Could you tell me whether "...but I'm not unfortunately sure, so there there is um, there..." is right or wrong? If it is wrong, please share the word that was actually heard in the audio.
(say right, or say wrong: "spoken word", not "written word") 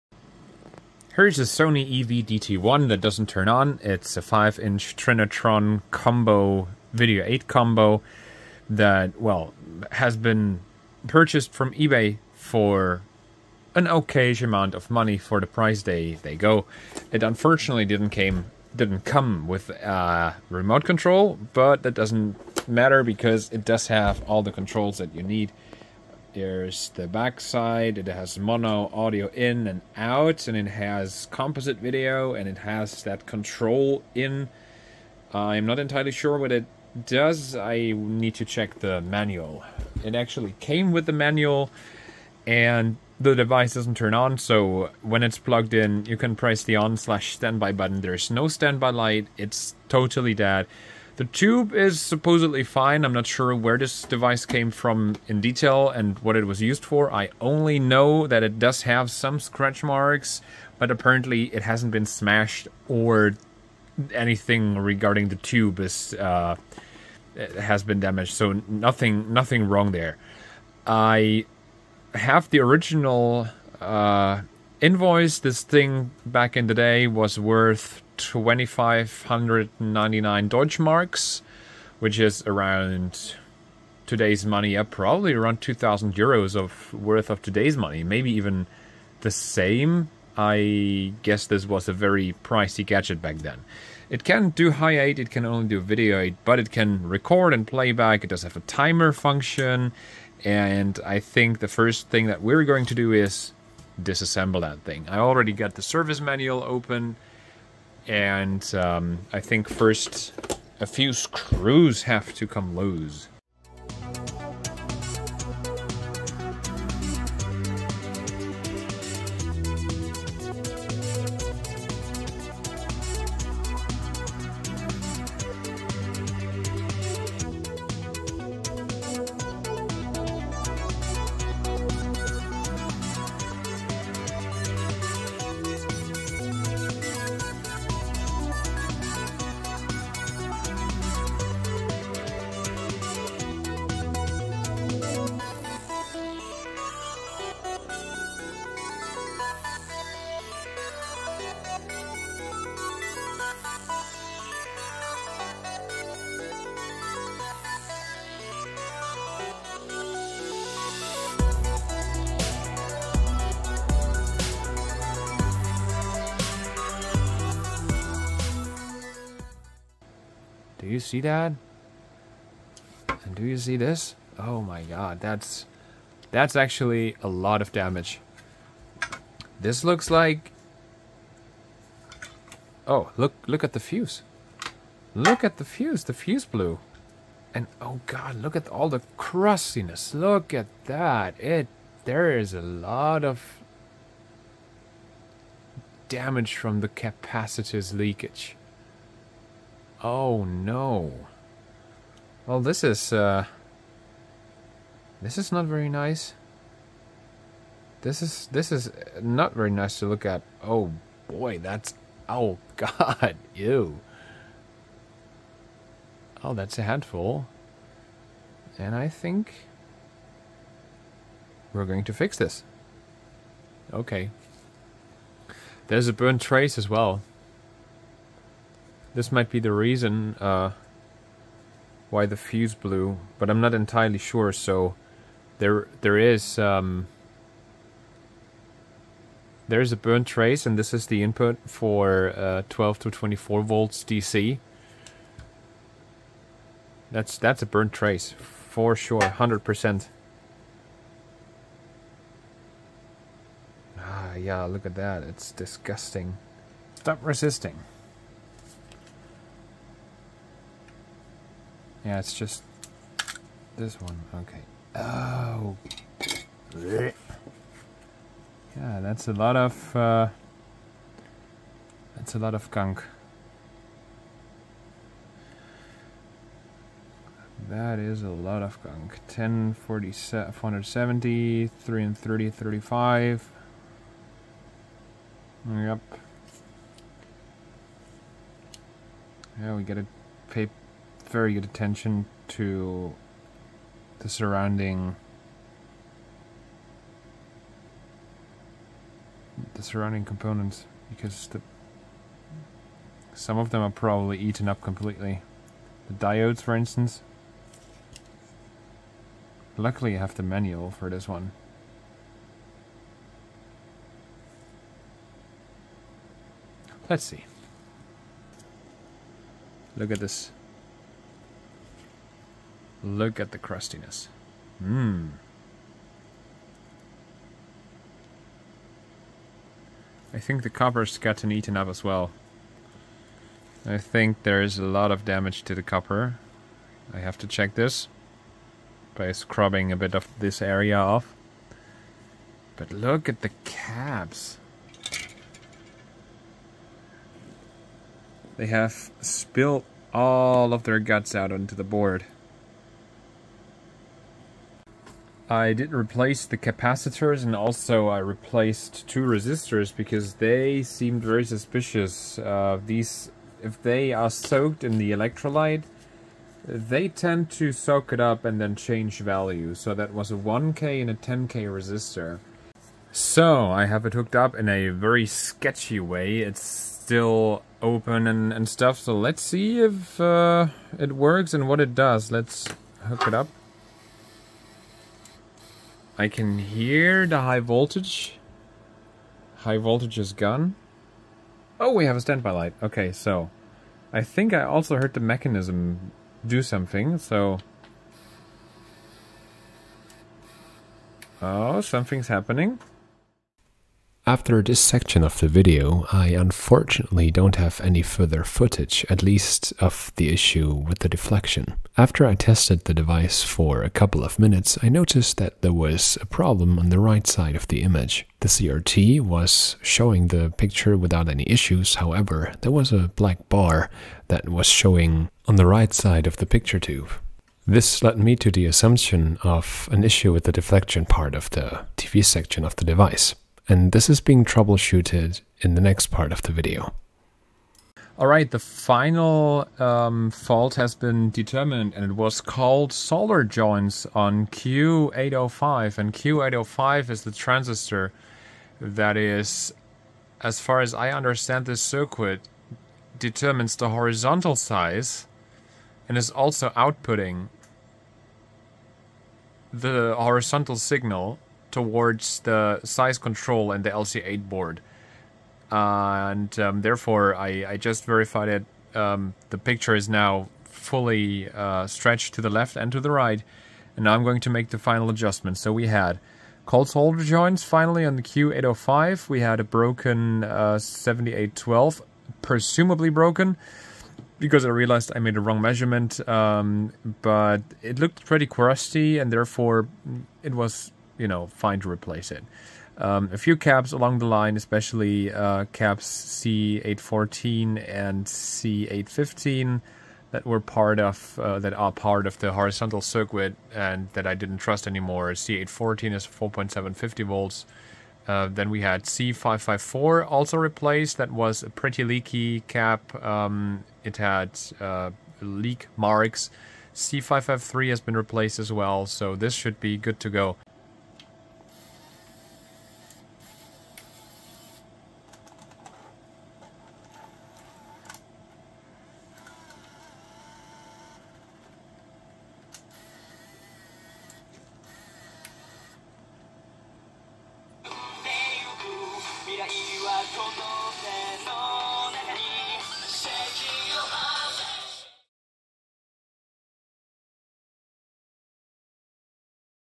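wrong: "entirely", not "unfortunately".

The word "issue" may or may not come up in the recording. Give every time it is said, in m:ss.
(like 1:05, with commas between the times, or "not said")
6:50, 7:01, 7:10.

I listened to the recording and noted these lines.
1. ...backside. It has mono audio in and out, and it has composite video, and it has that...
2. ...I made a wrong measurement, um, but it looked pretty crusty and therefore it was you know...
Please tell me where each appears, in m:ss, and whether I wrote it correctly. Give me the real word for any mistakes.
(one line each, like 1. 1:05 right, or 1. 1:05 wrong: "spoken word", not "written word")
1. 0:27 right
2. 8:05 right.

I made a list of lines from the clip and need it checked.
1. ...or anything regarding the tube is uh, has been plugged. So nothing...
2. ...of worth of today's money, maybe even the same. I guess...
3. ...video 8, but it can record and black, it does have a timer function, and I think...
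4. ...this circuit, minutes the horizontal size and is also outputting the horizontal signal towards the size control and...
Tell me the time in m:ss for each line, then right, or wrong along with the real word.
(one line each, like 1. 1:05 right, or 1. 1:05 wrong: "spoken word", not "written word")
1. 1:02 wrong: "damaged", not "plugged"
2. 1:26 right
3. 1:35 wrong: "playback", not "black"
4. 7:31 wrong: "determines", not "minutes".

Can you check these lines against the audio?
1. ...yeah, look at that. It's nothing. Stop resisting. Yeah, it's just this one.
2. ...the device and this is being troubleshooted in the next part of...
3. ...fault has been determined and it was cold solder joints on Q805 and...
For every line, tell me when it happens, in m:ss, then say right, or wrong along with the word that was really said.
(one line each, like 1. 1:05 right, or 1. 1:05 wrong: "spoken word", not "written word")
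1. 4:14 wrong: "disgusting", not "nothing"
2. 7:12 right
3. 7:20 right.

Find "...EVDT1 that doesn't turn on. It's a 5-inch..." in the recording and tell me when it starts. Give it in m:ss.
0:02.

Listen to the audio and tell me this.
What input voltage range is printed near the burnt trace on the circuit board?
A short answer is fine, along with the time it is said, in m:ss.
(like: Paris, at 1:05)
12 to 24 volts DC, at 4:02.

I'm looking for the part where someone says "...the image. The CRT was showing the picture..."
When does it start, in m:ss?
6:57.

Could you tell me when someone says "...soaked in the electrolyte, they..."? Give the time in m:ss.
6:04.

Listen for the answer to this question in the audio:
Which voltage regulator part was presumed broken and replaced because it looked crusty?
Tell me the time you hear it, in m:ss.
8:00.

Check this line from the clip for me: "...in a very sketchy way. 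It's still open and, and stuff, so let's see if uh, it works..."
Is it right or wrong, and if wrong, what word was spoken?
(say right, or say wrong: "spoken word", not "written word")
right.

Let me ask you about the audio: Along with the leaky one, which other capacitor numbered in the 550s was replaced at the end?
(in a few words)
C553.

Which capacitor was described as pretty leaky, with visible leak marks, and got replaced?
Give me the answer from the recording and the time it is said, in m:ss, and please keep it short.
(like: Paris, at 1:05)
C554, at 8:29.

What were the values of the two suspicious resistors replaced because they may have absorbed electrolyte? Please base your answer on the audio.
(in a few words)
1k and 10k.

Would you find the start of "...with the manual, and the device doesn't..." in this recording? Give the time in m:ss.
0:40.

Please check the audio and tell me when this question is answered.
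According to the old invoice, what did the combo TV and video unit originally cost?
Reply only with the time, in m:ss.
1:18.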